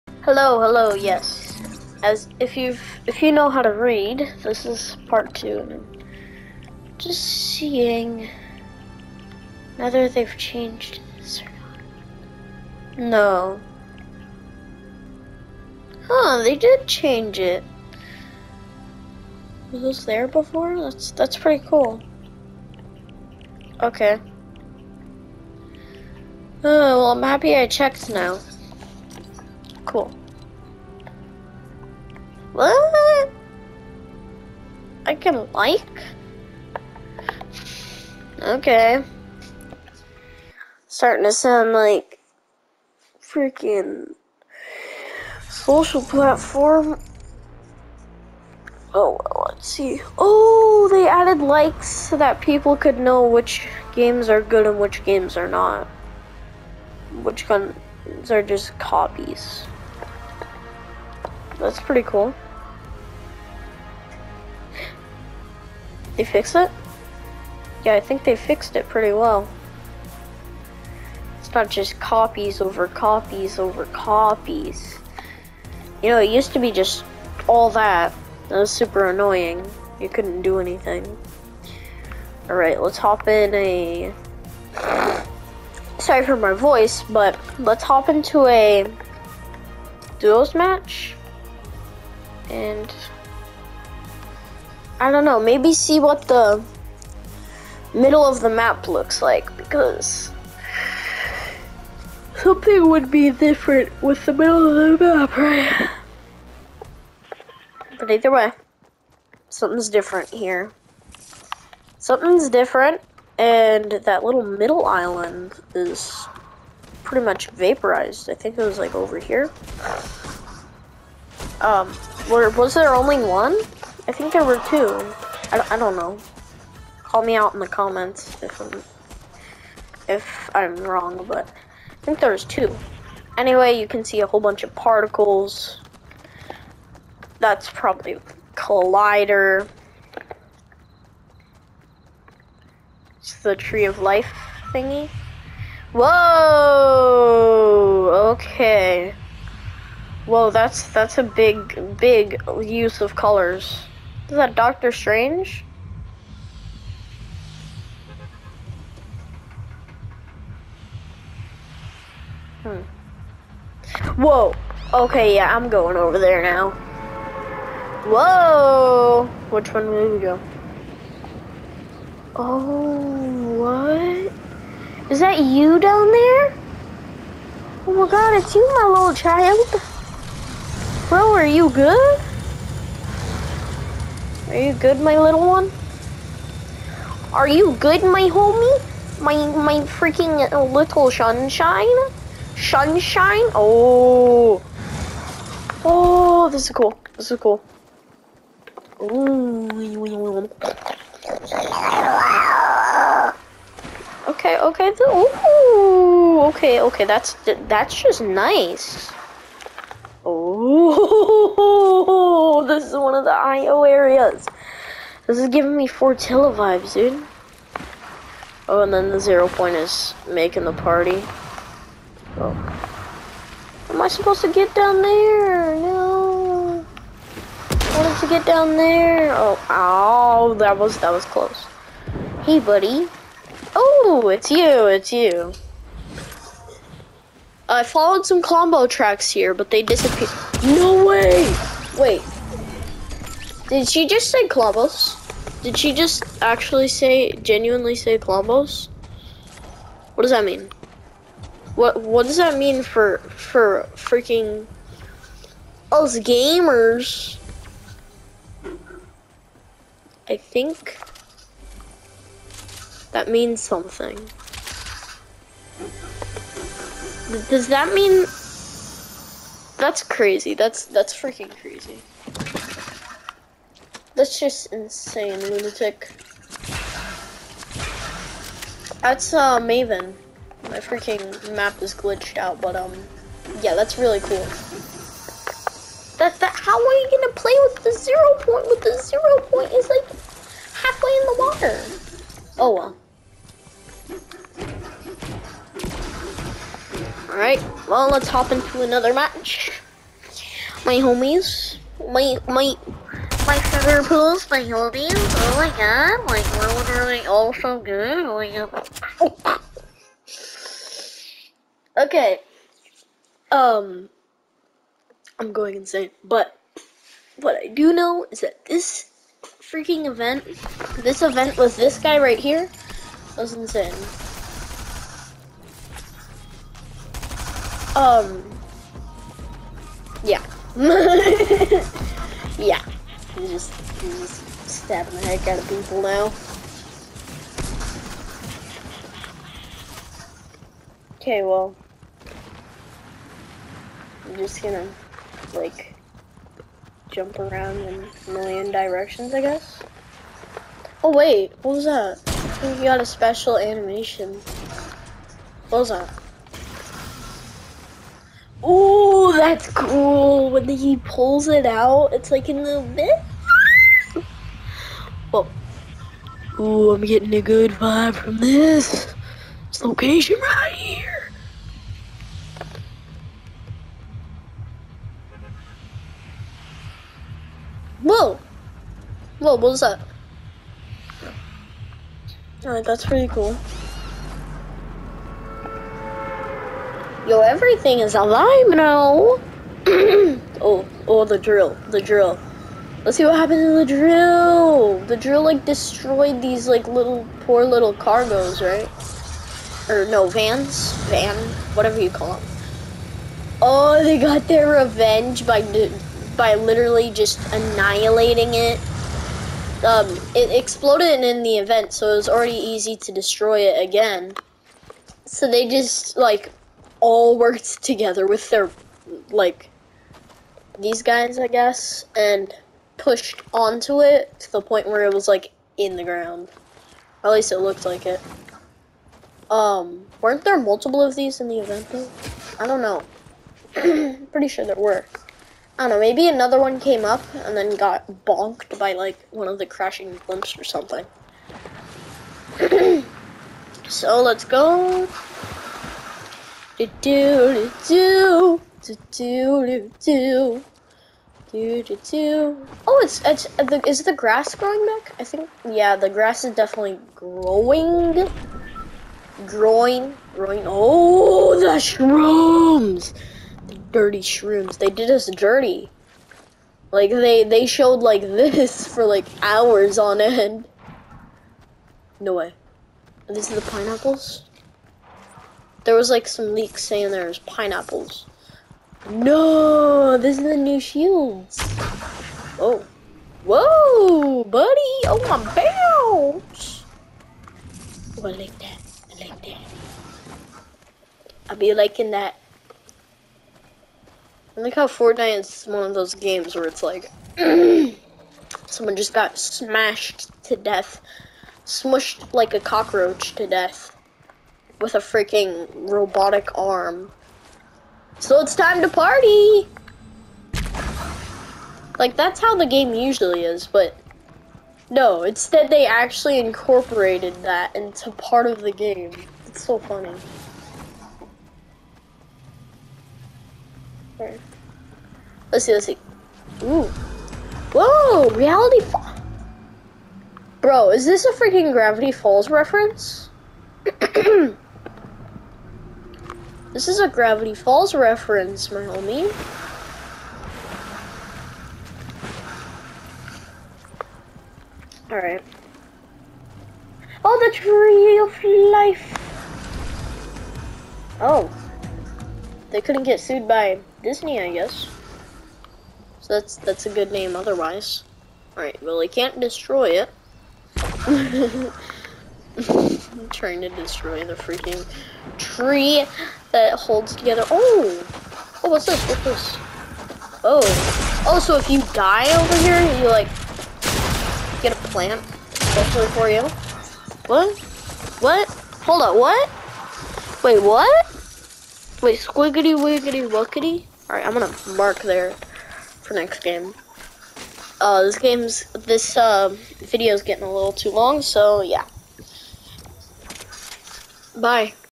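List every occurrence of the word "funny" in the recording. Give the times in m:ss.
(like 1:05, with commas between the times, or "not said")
8:39.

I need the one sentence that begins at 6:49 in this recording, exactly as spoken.
Um, it exploded in the event, so it was already easy to destroy it again.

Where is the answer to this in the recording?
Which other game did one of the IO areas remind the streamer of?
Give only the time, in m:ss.
3:35.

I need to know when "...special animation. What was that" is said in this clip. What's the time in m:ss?
5:53.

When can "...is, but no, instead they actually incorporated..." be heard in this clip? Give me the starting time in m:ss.
8:33.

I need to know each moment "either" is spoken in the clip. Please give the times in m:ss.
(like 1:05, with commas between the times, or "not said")
1:48.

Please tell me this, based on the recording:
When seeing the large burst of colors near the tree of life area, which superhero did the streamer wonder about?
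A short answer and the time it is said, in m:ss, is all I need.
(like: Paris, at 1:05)
Doctor Strange, at 2:34.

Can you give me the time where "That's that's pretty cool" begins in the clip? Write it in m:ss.
0:20.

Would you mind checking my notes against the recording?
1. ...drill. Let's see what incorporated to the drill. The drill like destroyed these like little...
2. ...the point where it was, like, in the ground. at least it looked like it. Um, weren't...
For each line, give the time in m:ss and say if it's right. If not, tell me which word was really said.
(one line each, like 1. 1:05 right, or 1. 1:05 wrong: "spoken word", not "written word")
1. 6:32 wrong: "happened", not "incorporated"
2. 7:04 right.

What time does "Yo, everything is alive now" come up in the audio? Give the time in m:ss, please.
6:27.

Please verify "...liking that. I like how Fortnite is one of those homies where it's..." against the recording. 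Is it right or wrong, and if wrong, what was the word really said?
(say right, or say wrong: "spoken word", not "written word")
wrong: "games", not "homies".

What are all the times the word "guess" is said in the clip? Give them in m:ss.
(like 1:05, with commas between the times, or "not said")
5:49, 7:01, 9:14.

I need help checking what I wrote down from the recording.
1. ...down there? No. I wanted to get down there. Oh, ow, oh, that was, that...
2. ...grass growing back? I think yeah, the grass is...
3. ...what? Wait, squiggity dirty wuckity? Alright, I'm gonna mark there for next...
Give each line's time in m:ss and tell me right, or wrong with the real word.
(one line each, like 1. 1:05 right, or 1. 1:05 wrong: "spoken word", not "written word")
1. 3:44 right
2. 7:34 right
3. 9:40 wrong: "wiggity", not "dirty".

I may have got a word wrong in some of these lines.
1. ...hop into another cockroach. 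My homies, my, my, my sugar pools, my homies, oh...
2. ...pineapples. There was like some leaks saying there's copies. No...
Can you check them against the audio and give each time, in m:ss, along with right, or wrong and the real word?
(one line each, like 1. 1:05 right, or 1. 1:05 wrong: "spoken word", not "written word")
1. 4:58 wrong: "match", not "cockroach"
2. 7:53 wrong: "pineapples", not "copies".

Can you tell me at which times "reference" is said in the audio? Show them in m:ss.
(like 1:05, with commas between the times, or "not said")
8:52, 8:57.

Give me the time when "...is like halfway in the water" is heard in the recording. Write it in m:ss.
4:49.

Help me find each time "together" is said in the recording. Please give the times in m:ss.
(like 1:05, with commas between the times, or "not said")
6:57, 9:27.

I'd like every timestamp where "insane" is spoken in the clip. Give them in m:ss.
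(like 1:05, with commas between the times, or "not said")
4:34, 5:15, 5:23.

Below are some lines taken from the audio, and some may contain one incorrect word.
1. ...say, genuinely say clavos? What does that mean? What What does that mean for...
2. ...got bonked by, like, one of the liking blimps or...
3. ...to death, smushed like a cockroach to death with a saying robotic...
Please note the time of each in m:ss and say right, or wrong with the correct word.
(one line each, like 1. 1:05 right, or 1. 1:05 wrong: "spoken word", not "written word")
1. 4:06 right
2. 7:17 wrong: "crashing", not "liking"
3. 8:20 wrong: "freaking", not "saying".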